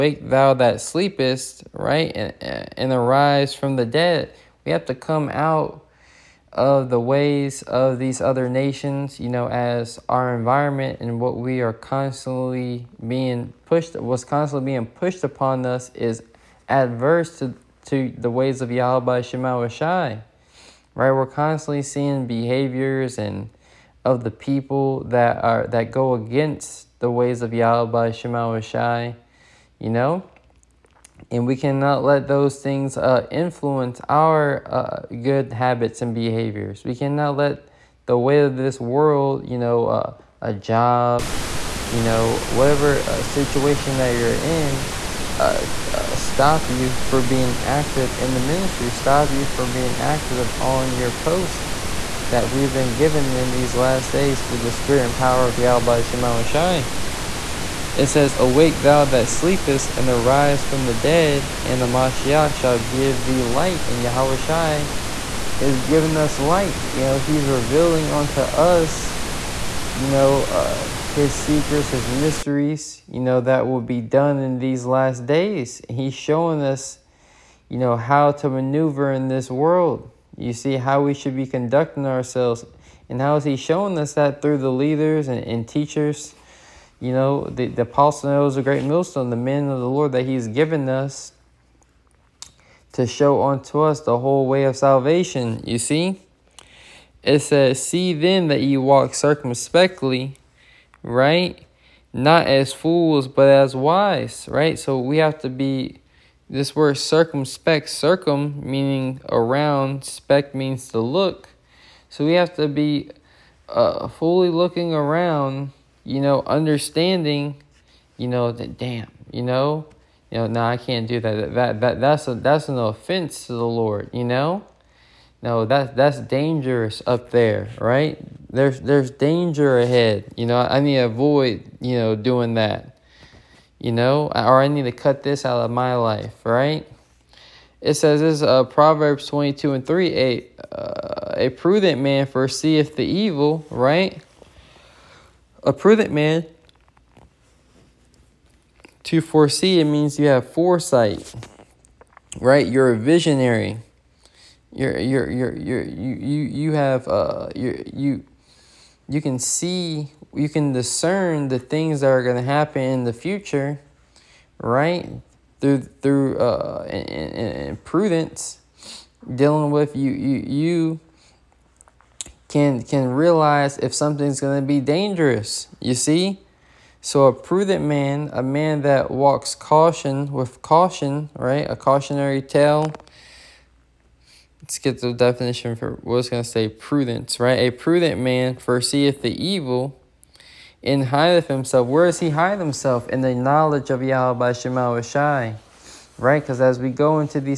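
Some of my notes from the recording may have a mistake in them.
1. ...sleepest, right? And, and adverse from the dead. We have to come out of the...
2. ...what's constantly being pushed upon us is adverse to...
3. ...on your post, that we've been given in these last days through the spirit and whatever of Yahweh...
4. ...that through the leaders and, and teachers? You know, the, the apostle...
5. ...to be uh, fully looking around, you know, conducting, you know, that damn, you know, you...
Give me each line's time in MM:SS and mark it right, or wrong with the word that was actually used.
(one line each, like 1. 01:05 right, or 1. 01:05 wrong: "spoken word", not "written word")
1. 00:00 wrong: "arise", not "adverse"
2. 00:13 right
3. 00:50 wrong: "power", not "whatever"
4. 01:24 right
5. 01:52 wrong: "understanding", not "conducting".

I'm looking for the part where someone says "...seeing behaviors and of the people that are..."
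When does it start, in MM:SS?
00:21.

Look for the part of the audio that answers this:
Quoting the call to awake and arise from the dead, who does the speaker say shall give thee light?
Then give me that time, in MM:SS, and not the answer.
01:01.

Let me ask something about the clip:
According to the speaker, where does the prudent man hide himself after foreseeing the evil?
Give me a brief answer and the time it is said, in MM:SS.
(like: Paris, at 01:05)
In the knowledge of Yahweh, at 03:13.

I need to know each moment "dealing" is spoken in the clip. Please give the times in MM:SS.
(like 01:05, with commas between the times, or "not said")
02:49.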